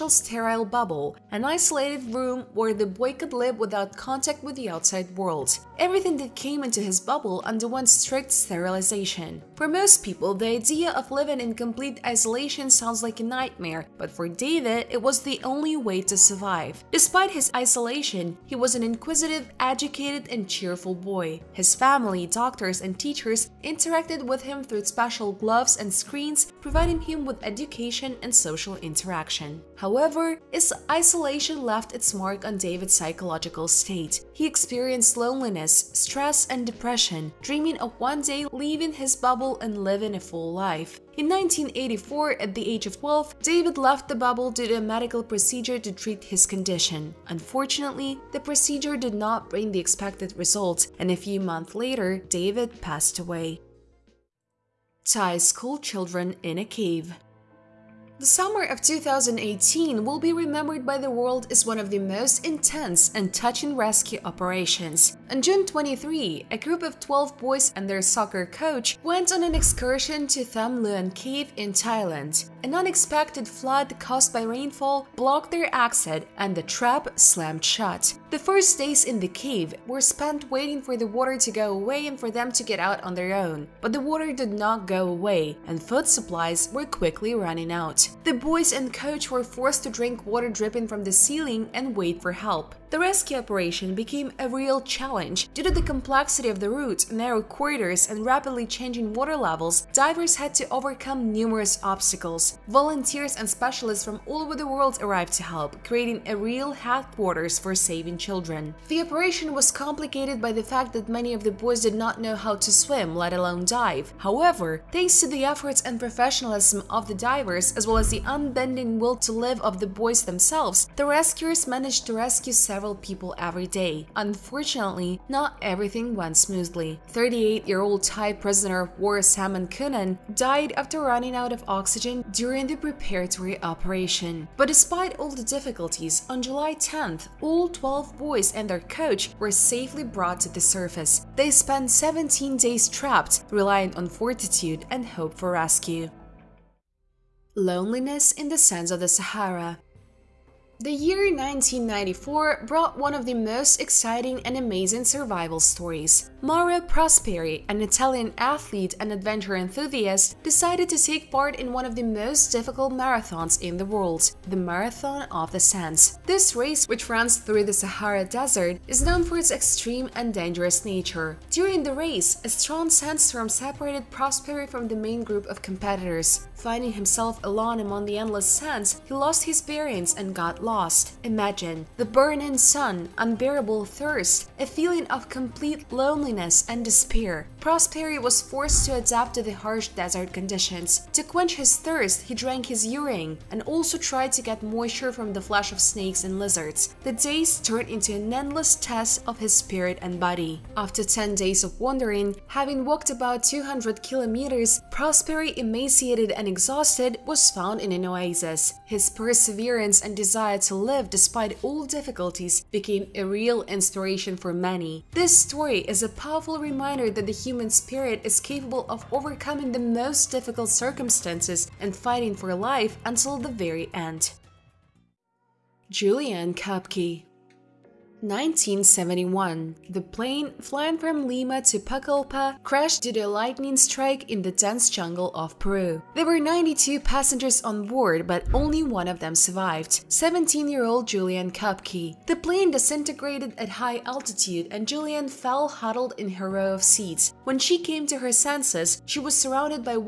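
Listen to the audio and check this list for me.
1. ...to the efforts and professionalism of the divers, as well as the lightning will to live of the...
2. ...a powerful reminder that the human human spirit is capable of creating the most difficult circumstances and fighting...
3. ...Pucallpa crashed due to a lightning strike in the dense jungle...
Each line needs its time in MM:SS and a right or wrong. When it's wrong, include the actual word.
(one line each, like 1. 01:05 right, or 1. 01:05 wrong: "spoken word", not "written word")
1. 01:55 wrong: "unbending", not "lightning"
2. 03:36 wrong: "overcoming", not "creating"
3. 03:51 right.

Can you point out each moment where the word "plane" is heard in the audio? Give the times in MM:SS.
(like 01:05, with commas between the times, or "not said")
03:50, 04:02.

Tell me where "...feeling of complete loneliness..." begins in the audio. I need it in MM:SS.
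03:04.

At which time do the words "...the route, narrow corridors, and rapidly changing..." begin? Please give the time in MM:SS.
01:36.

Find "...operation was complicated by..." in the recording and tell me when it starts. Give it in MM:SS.
01:49.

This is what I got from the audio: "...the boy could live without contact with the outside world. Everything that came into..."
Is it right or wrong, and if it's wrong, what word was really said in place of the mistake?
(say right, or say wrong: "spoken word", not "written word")
right.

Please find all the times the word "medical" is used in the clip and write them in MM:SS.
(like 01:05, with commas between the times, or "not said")
00:44.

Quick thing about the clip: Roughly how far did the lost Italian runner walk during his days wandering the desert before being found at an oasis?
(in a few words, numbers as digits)
200 kilometers.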